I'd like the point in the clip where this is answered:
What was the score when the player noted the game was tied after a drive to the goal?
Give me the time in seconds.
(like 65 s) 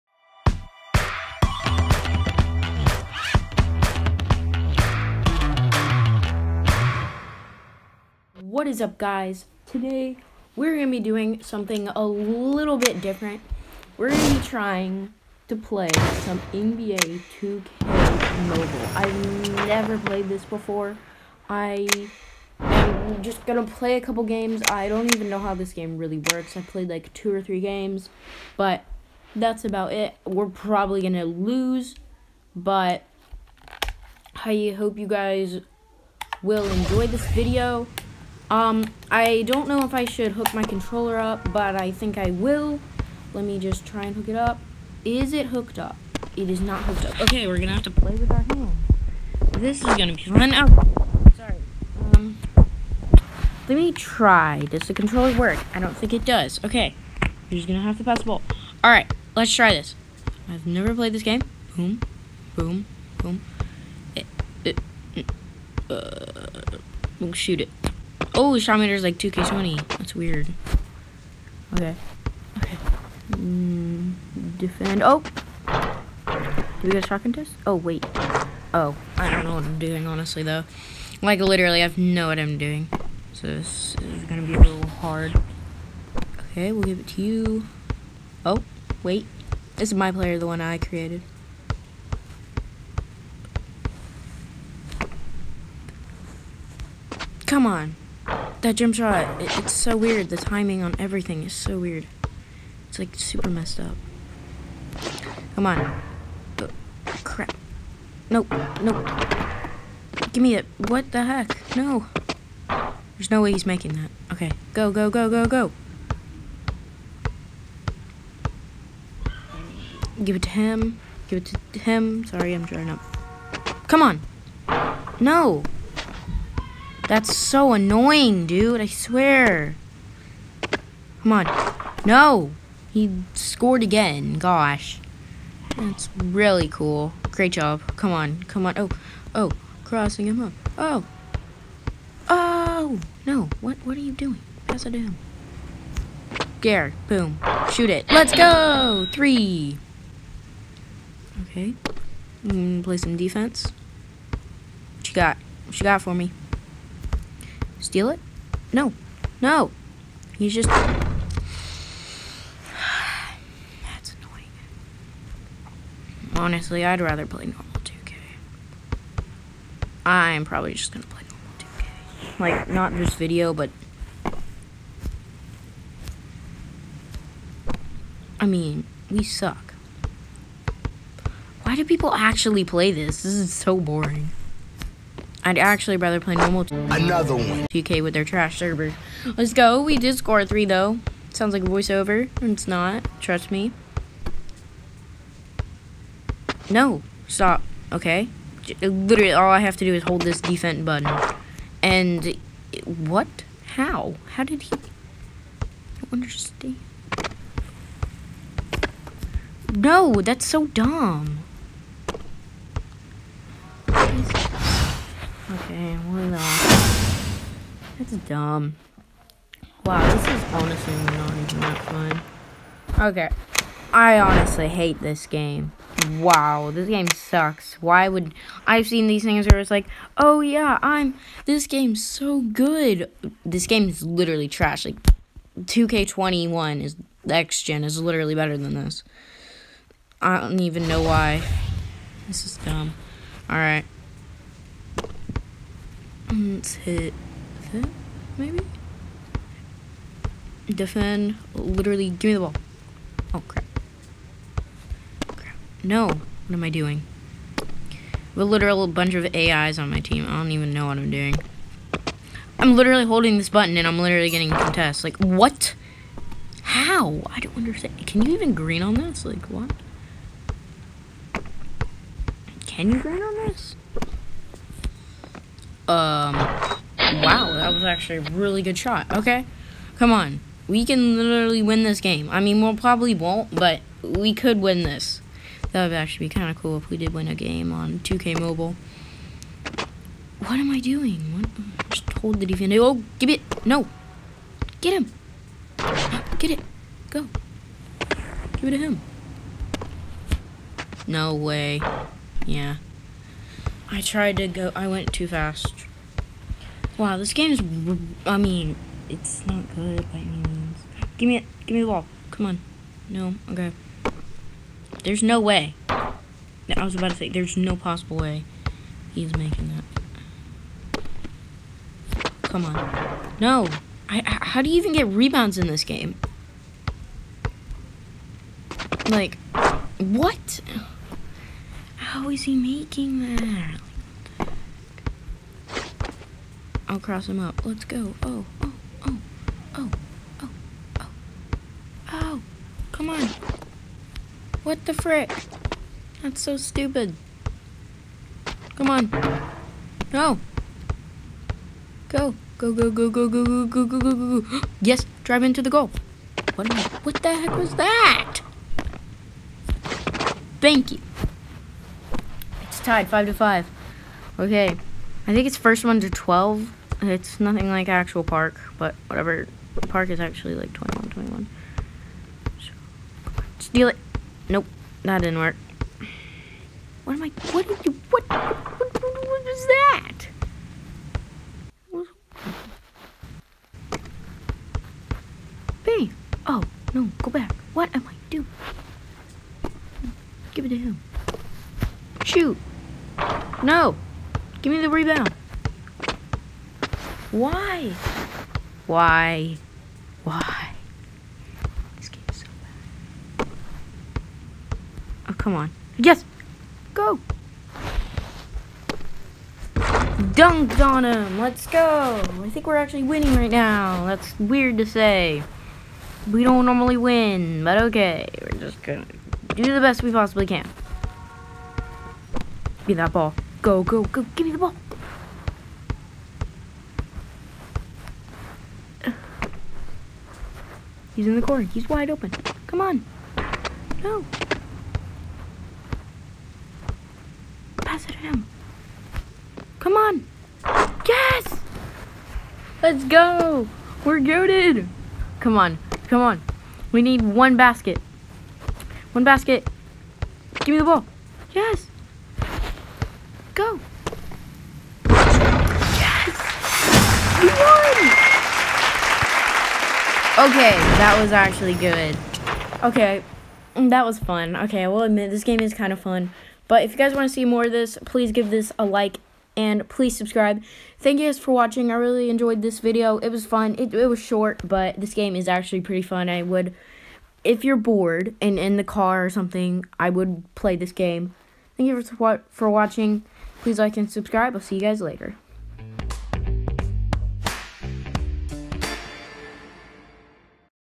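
363 s.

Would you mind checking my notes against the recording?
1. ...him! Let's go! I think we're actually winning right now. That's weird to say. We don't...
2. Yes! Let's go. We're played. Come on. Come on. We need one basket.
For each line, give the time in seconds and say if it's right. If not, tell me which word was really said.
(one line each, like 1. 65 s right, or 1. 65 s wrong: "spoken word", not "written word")
1. 411 s right
2. 441 s wrong: "goaded", not "played".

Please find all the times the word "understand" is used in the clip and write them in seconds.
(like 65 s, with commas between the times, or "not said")
206 s, 267 s.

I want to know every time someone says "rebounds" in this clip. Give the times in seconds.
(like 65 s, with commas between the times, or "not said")
325 s, 394 s.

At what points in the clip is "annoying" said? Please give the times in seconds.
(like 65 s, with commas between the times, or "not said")
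127 s, 164 s.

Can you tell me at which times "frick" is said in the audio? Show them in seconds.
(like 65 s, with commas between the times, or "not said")
344 s.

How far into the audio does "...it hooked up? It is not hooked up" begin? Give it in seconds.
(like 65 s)
45 s.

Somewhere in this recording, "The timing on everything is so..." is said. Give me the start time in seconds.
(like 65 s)
100 s.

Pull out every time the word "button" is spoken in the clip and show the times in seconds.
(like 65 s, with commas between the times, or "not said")
200 s, 263 s.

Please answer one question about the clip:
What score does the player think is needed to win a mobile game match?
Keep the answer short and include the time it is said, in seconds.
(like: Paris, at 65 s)
12, at 365 s.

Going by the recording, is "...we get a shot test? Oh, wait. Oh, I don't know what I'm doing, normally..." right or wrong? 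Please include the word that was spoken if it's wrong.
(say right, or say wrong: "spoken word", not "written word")
wrong: "honestly", not "normally".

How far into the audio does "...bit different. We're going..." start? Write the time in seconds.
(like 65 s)
12 s.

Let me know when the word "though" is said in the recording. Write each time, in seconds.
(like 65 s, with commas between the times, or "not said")
80 s, 190 s.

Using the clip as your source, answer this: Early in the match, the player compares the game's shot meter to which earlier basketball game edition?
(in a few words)
2K20.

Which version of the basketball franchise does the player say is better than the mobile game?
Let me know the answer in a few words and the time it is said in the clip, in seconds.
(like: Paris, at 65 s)
2K21 next gen, at 235 s.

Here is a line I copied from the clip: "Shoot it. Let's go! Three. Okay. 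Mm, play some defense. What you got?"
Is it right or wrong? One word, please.
right.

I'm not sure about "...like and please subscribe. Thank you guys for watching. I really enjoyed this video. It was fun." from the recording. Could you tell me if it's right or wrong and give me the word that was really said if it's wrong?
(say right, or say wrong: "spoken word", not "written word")
right.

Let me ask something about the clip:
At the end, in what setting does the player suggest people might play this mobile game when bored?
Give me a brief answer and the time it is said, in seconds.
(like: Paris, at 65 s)
in the car, at 478 s.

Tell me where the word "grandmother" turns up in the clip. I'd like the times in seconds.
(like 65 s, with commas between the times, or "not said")
not said.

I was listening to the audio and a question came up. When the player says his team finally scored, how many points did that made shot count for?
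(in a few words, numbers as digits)
3.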